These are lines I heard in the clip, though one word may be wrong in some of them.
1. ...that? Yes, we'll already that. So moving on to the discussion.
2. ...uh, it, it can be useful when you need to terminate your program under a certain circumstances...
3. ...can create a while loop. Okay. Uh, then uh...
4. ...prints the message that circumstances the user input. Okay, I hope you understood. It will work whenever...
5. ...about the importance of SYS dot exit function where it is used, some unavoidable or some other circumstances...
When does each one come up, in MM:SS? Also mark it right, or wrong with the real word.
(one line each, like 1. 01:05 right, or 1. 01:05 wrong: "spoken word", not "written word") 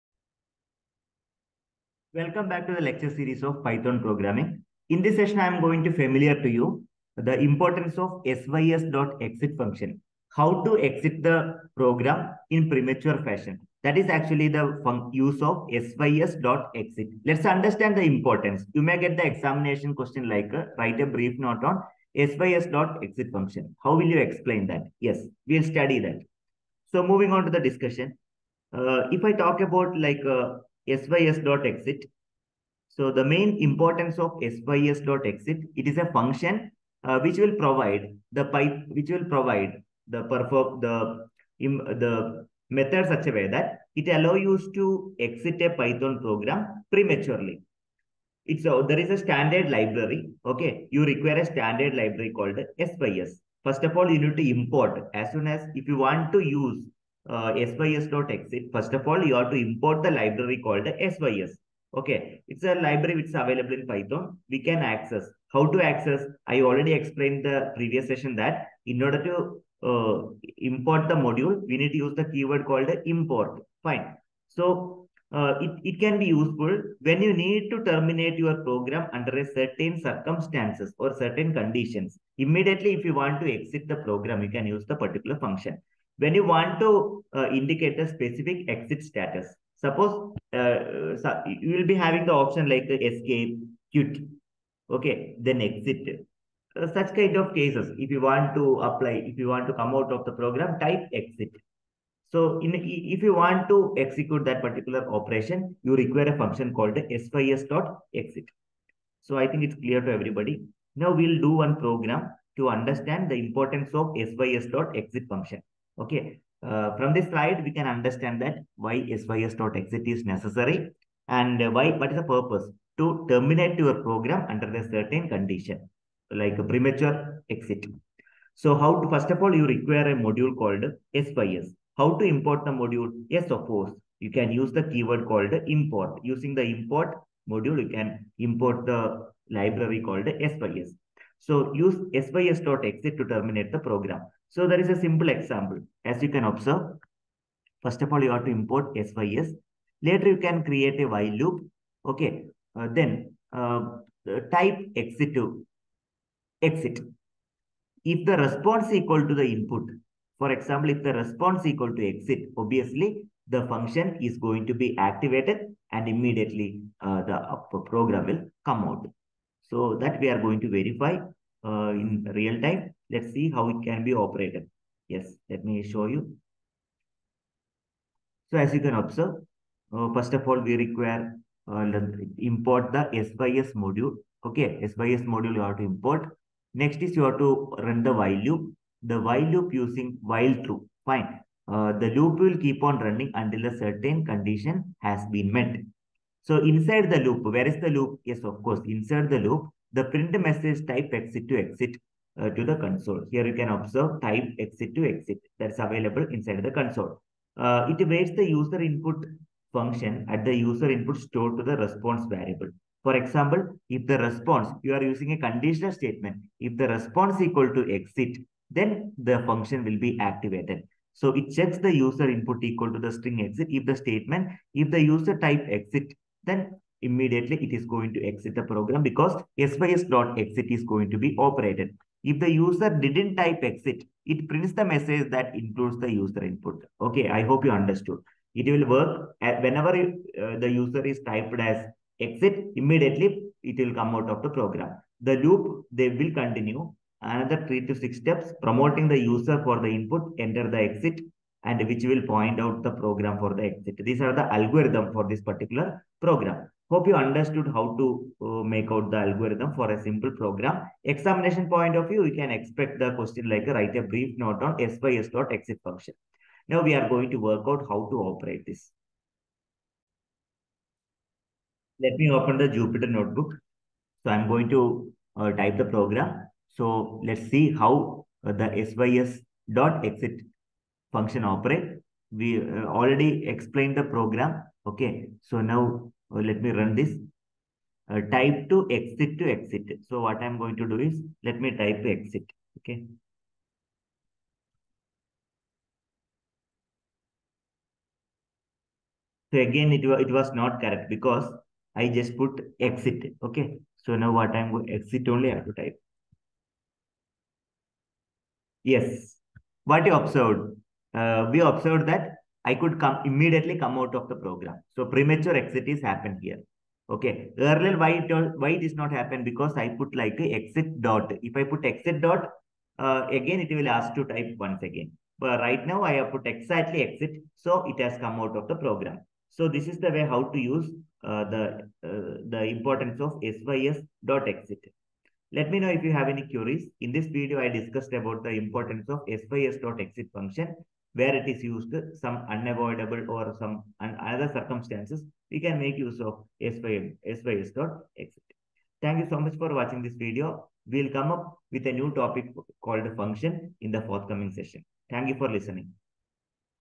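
1. 00:24 wrong: "study", not "already"
2. 01:15 right
3. 02:30 right
4. 03:54 wrong: "includes", not "circumstances"
5. 05:38 right.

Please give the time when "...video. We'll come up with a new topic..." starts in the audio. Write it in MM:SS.
05:50.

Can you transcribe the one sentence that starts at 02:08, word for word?
So how to, first of all, you require a module called sys.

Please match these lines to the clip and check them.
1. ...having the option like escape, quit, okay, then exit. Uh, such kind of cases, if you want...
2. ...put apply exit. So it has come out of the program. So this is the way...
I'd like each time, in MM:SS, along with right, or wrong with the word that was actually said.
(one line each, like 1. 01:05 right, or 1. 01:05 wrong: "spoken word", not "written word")
1. 01:31 right
2. 05:26 wrong: "exactly", not "apply".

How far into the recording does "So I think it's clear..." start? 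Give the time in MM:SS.
01:49.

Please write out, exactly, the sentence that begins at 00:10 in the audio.
How to exit the program in premature fashion.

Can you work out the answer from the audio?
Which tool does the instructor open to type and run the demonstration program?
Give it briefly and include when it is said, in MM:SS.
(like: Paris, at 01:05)
Jupyter notebook, at 04:32.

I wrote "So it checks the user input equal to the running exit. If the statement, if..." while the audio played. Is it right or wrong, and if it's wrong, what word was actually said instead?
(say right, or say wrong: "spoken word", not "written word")
wrong: "string", not "running".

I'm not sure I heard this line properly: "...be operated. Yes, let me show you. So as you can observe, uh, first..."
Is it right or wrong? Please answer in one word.
right.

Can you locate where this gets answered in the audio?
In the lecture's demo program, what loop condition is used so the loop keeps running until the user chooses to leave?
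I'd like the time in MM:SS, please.
03:10.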